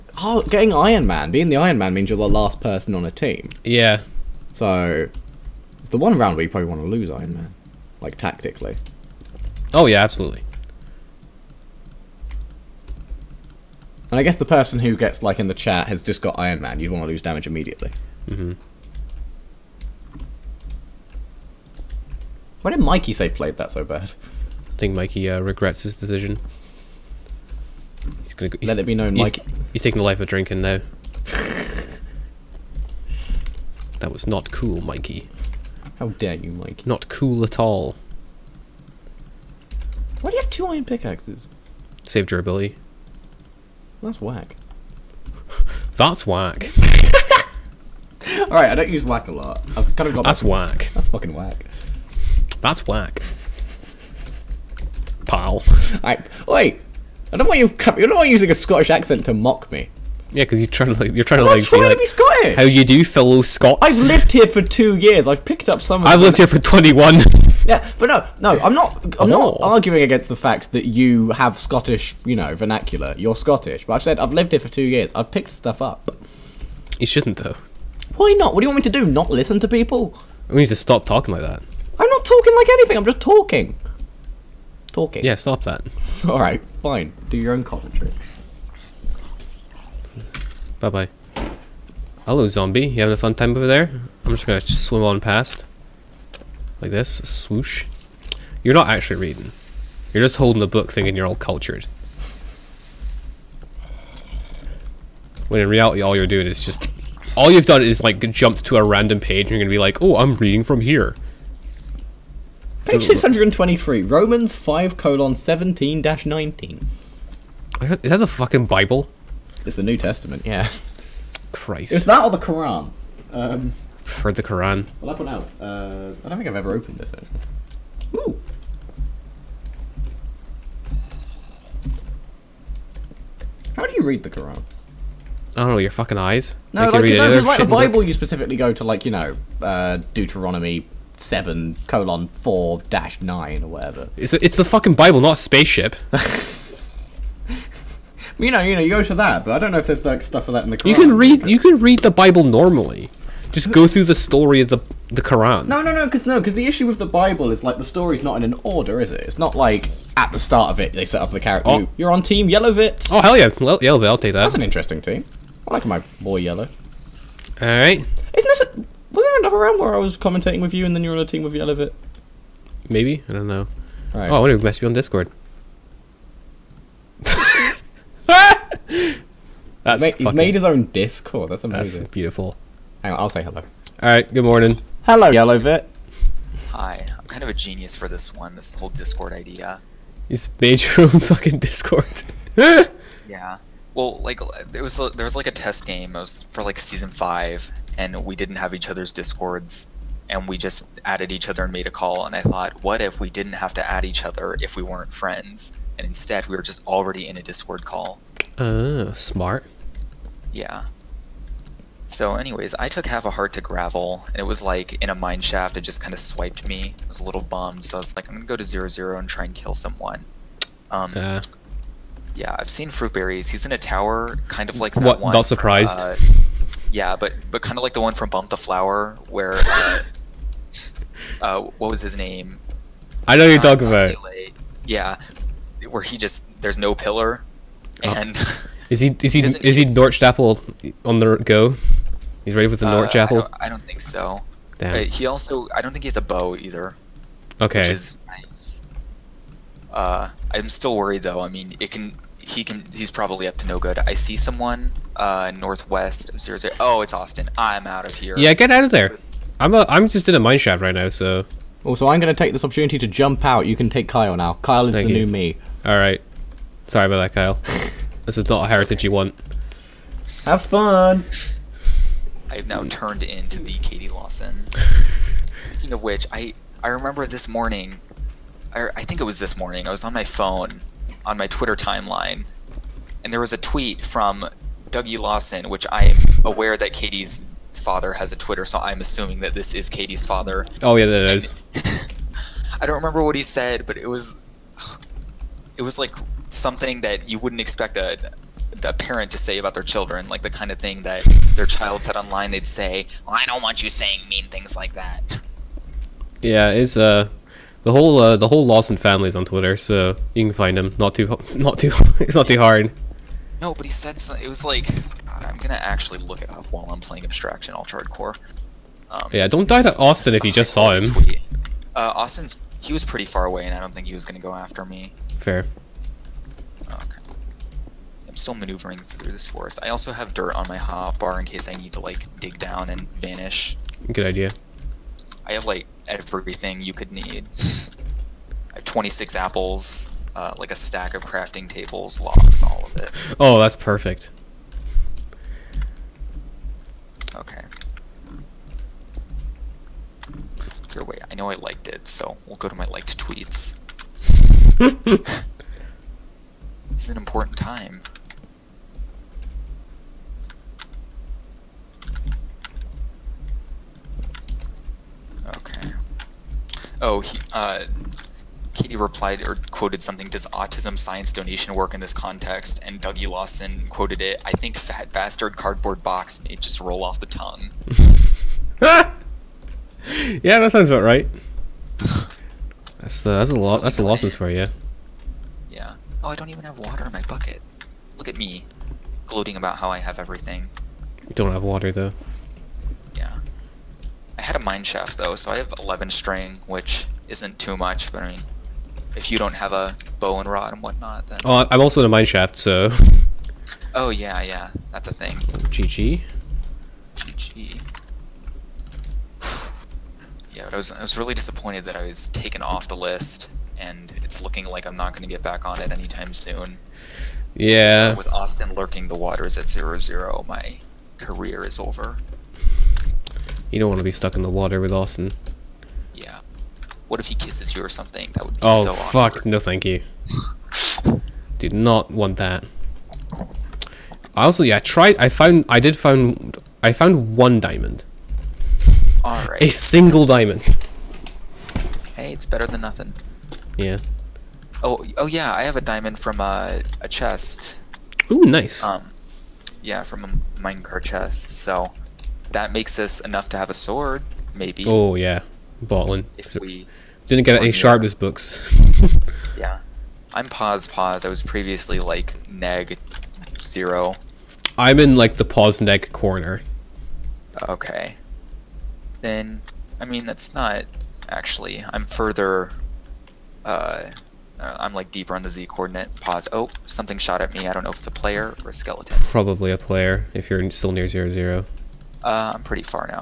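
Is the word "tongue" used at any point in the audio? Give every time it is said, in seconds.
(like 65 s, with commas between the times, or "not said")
377 s.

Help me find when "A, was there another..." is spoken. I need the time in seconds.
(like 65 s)
168 s.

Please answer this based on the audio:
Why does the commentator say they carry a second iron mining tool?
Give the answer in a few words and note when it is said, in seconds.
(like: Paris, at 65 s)
Save durability, at 42 s.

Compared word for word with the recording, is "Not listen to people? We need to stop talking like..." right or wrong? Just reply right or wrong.
right.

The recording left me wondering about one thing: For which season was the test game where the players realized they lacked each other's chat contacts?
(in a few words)
Season 5.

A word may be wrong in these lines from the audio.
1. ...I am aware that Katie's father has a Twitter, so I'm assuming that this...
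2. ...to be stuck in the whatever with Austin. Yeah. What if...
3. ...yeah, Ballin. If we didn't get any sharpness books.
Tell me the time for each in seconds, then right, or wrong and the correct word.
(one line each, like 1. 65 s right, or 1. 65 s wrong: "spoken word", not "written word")
1. 285 s right
2. 423 s wrong: "water", not "whatever"
3. 455 s right.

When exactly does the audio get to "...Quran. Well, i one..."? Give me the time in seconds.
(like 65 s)
124 s.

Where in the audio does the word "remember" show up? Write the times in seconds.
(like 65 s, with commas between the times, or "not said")
276 s, 292 s.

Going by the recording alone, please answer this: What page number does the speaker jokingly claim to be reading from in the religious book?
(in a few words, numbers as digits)
623.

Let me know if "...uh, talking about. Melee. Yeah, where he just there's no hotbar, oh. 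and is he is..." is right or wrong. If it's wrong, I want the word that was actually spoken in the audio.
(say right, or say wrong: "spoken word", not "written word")
wrong: "pillar", not "hotbar".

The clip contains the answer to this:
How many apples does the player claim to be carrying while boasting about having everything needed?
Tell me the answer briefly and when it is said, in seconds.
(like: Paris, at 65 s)
26, at 338 s.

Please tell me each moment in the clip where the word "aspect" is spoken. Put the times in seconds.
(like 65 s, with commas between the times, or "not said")
not said.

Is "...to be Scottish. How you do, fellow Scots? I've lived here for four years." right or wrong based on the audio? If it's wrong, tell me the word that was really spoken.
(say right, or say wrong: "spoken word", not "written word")
wrong: "two", not "four".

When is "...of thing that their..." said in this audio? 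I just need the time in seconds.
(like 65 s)
300 s.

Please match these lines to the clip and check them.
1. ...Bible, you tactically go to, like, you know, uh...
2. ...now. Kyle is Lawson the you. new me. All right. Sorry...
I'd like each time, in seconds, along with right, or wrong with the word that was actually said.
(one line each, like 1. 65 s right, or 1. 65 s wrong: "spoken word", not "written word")
1. 137 s wrong: "specifically", not "tactically"
2. 264 s wrong: "Thank", not "Lawson".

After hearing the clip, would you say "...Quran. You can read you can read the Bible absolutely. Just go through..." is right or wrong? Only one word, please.
wrong.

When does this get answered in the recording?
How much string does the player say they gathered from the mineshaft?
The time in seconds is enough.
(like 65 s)
395 s.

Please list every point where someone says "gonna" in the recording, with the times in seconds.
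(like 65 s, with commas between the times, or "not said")
28 s, 94 s, 109 s, 218 s, 315 s, 324 s.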